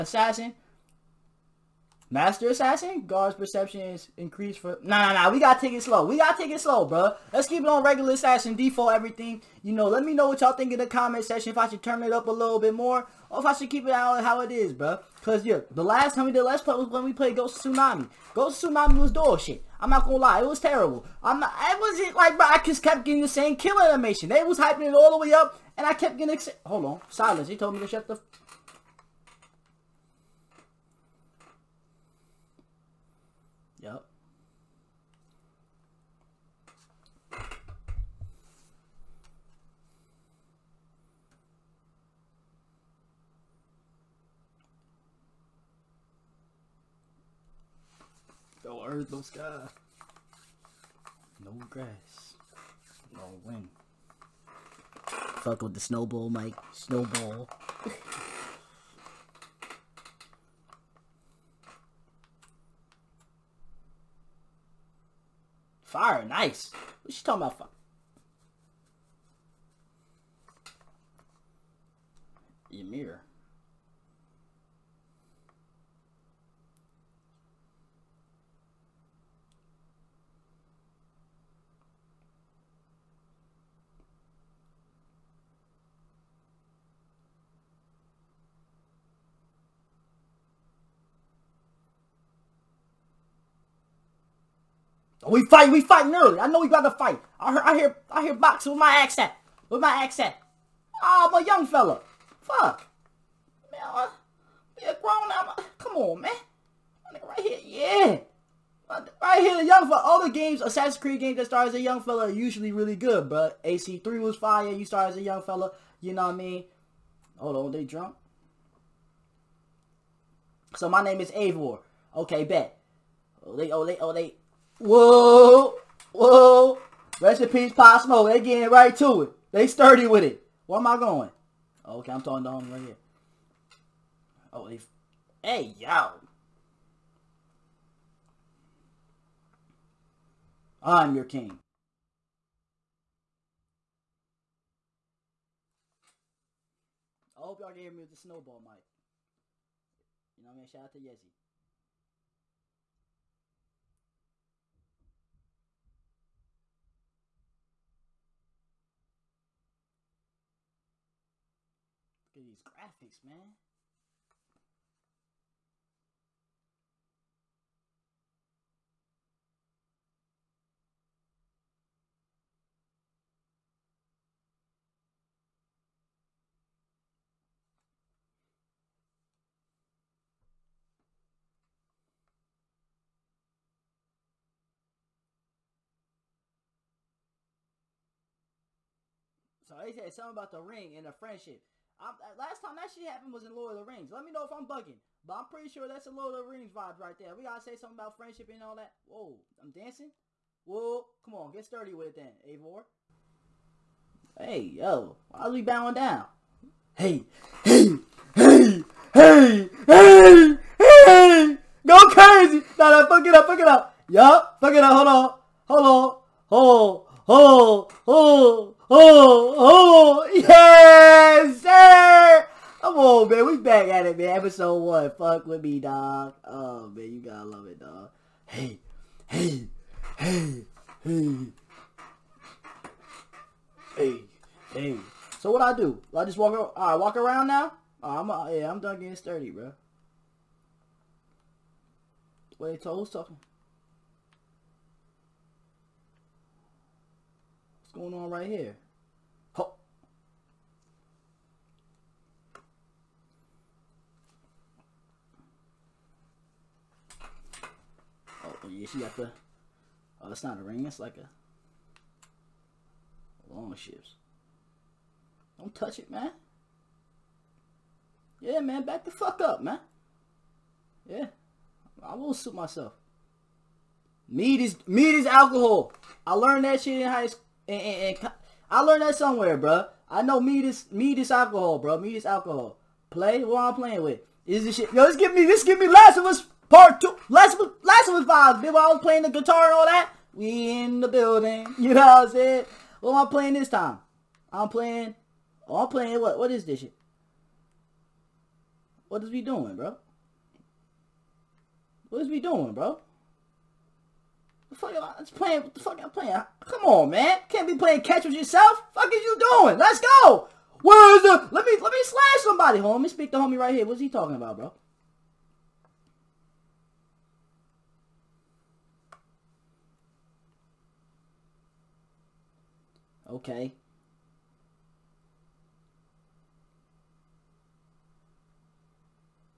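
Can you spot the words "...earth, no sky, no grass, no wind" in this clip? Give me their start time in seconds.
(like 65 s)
48 s.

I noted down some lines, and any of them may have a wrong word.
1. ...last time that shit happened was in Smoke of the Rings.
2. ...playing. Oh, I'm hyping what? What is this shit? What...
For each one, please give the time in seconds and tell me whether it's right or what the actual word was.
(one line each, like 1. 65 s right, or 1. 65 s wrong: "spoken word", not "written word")
1. 192 s wrong: "Lord", not "Smoke"
2. 294 s wrong: "playing", not "hyping".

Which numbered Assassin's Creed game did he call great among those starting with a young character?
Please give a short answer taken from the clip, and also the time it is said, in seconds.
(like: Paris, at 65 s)
AC3, at 113 s.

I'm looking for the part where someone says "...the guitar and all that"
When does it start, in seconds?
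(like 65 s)
289 s.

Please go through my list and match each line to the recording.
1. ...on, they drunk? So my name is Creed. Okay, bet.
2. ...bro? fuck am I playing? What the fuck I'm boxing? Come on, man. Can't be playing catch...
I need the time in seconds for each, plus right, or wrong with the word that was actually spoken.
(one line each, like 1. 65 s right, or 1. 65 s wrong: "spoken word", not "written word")
1. 117 s wrong: "Eivor", not "Creed"
2. 302 s wrong: "playing", not "boxing".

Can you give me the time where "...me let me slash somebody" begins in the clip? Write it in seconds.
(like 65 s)
311 s.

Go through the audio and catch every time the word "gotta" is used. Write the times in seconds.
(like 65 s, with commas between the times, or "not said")
197 s, 227 s.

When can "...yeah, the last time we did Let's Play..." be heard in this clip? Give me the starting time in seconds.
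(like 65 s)
15 s.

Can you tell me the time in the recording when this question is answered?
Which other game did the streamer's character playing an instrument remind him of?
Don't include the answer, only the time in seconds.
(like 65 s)
285 s.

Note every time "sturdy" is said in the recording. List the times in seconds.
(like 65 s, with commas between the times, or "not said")
129 s, 201 s, 239 s.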